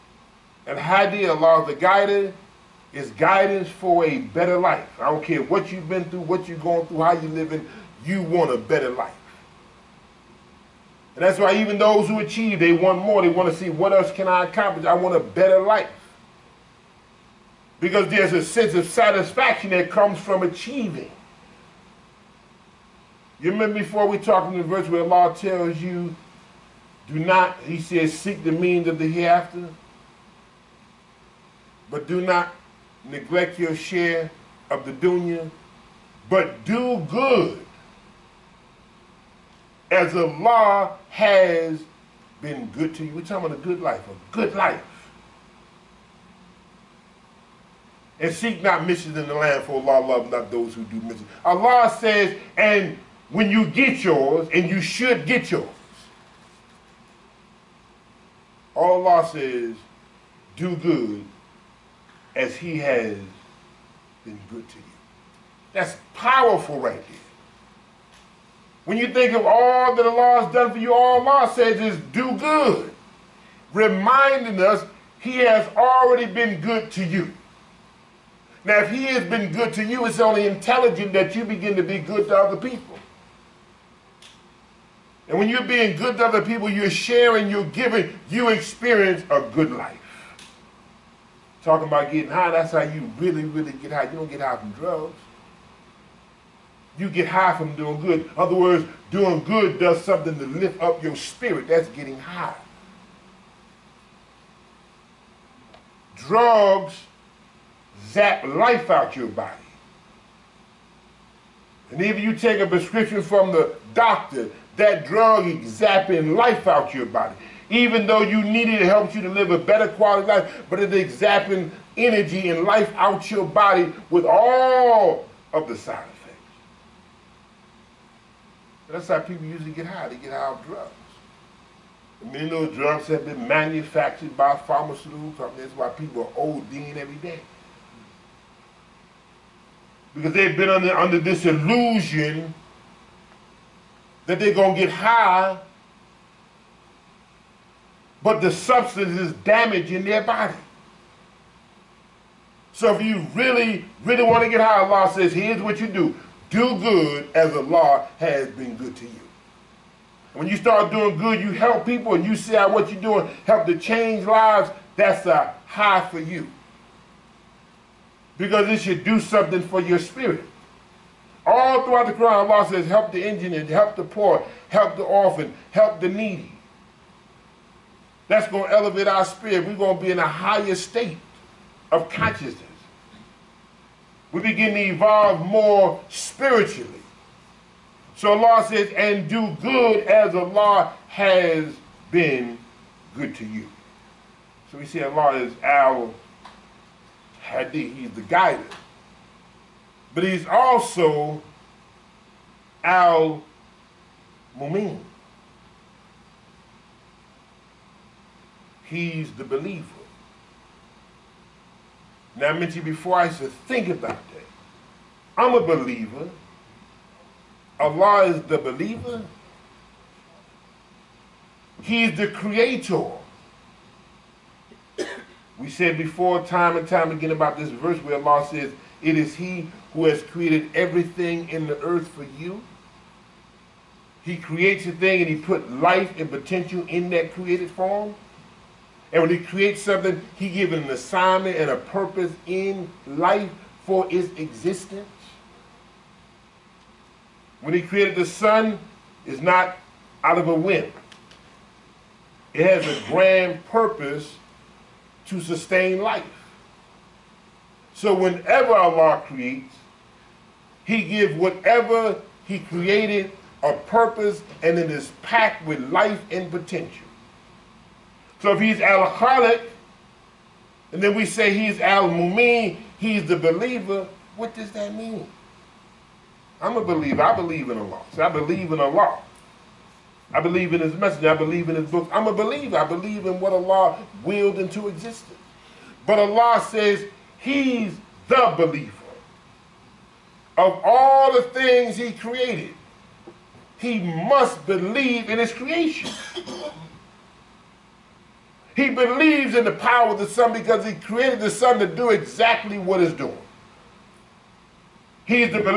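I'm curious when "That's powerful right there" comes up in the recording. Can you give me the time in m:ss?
1:05.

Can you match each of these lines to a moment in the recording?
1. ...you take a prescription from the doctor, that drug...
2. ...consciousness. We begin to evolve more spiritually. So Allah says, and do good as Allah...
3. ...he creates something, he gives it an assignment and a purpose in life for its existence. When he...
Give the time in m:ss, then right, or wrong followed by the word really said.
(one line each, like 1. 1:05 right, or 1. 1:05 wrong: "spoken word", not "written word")
1. 1:52 right
2. 3:02 right
3. 3:59 right.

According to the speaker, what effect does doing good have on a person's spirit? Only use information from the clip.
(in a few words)
lift up your spirit.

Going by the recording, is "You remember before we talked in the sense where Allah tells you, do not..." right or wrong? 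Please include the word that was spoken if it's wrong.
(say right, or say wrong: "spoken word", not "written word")
wrong: "verse", not "sense".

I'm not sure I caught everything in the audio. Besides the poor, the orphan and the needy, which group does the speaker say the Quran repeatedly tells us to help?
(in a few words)
the injured.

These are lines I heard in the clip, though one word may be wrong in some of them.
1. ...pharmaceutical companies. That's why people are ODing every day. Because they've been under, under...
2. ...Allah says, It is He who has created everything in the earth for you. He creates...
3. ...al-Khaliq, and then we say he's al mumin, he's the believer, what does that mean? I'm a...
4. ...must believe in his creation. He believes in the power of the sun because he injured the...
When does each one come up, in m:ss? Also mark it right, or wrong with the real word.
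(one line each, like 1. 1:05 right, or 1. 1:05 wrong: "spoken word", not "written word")
1. 2:14 right
2. 3:48 right
3. 4:28 right
4. 4:53 wrong: "created", not "injured".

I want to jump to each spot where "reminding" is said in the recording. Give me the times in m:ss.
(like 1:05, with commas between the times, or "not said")
1:13.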